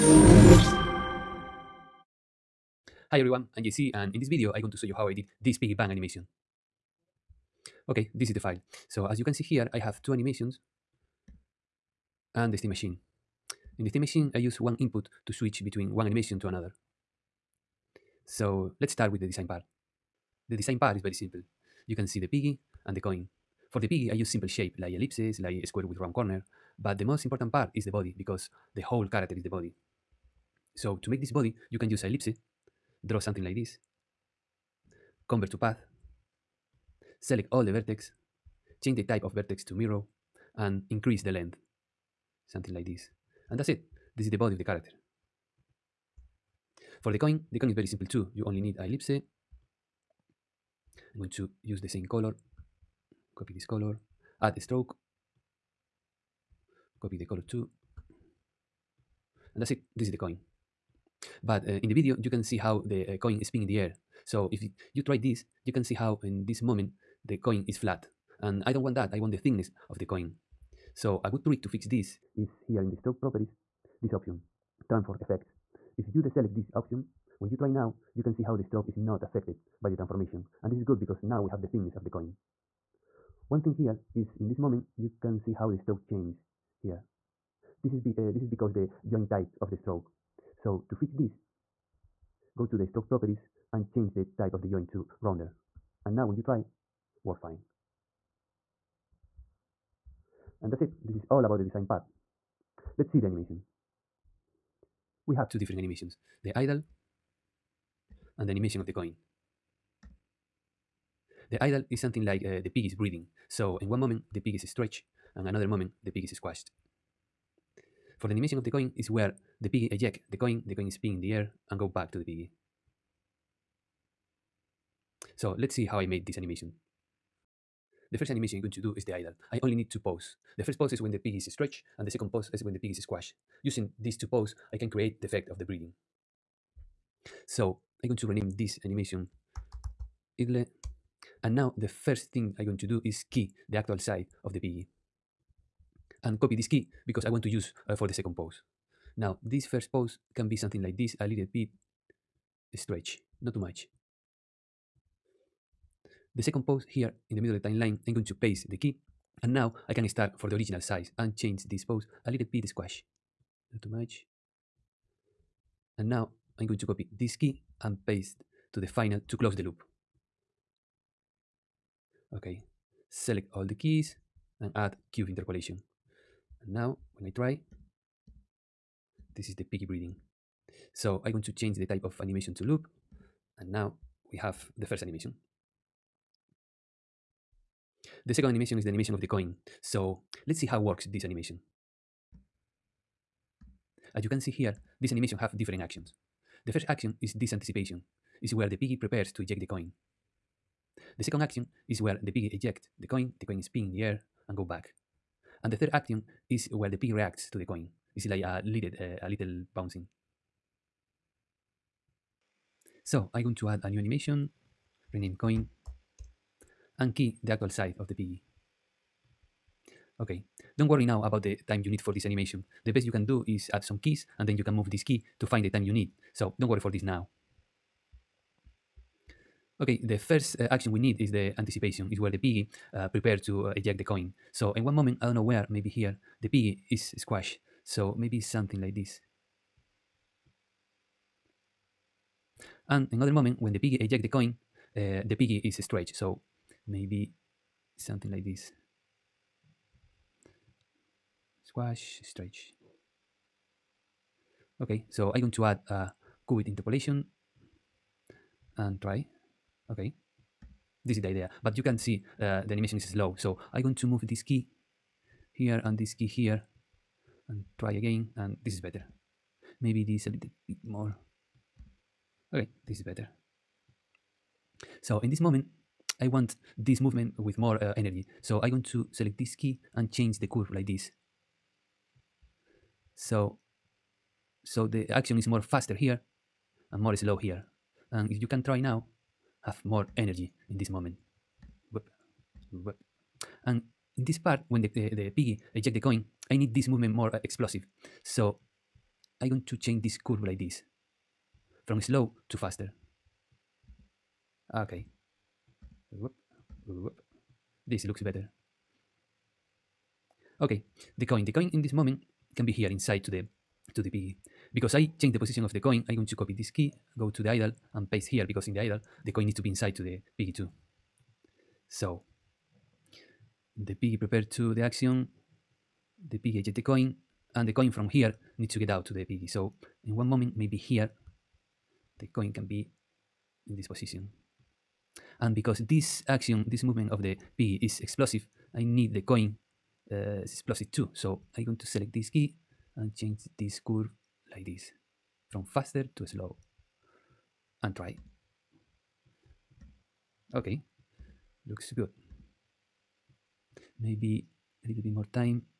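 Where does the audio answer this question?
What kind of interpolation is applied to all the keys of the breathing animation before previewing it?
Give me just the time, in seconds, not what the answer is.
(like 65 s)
175 s.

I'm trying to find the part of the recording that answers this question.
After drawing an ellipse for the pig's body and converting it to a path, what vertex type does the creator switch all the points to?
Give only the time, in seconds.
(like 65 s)
39 s.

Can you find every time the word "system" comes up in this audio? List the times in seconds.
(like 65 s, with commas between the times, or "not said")
not said.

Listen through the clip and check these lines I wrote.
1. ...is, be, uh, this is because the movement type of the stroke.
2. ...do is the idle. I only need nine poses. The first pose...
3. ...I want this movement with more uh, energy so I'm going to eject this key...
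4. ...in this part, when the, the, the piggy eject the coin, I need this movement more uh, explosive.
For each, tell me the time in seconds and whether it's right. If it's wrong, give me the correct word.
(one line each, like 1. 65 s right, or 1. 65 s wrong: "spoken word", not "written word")
1. 87 s wrong: "joint", not "movement"
2. 128 s wrong: "two", not "nine"
3. 276 s wrong: "select", not "eject"
4. 294 s right.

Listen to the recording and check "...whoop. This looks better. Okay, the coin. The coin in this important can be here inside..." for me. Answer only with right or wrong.
wrong.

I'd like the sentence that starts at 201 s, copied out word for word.
The second action is where the piggy ejects the coin, the coin is pinned in the air and go back.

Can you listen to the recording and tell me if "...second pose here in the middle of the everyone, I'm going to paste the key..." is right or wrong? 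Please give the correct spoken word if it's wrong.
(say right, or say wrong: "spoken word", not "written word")
wrong: "timeline", not "everyone".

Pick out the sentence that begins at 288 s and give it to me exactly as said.
And if you can try now, have more energy in this moment.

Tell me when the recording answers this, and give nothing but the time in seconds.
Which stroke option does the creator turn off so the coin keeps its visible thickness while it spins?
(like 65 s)
74 s.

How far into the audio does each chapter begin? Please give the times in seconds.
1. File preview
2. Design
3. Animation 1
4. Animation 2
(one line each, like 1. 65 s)
1. 8 s
2. 20 s
3. 128 s
4. 211 s.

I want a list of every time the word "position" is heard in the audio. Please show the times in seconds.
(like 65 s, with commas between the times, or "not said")
315 s, 333 s.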